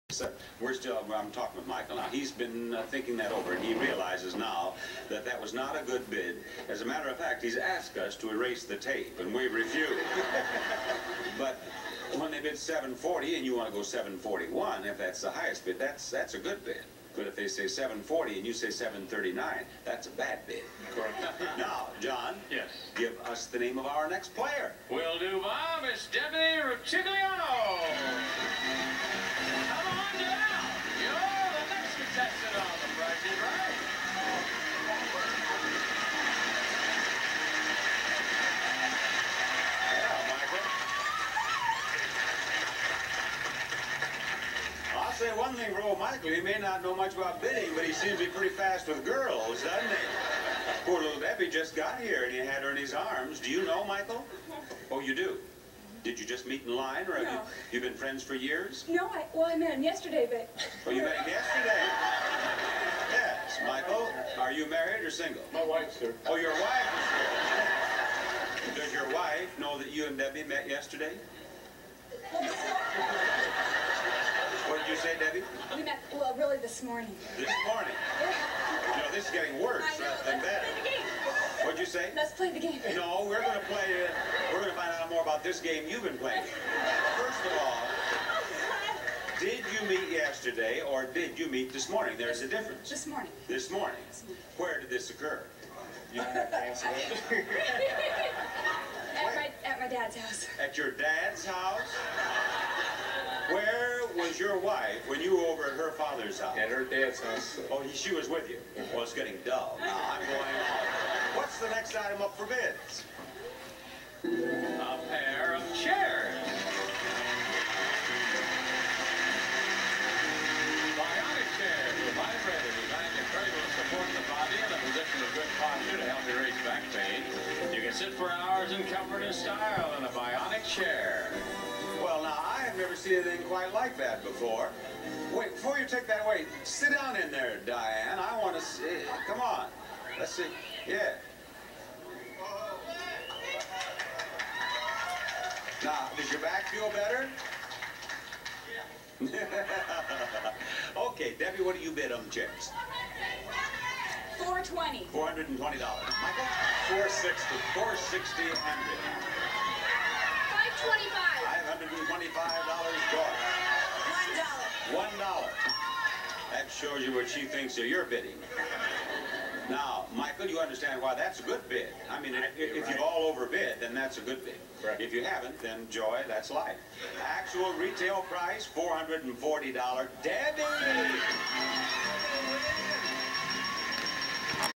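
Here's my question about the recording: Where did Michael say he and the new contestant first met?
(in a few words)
At my dad's house.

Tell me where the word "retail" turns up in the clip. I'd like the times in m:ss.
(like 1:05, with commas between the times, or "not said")
2:57.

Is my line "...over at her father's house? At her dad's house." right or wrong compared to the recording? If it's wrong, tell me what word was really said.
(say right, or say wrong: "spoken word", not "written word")
right.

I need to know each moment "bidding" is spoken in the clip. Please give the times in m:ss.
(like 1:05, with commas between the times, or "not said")
0:47, 2:48.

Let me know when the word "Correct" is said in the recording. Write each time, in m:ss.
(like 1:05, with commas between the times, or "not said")
0:20, 2:54.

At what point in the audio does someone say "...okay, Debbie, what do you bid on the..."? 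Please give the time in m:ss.
2:31.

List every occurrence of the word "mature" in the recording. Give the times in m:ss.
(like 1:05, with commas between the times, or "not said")
not said.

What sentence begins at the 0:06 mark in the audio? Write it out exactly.
As a matter of fact, he's asked us to erase the tape, and we refused.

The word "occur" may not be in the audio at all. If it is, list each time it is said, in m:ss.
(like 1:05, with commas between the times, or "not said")
1:35.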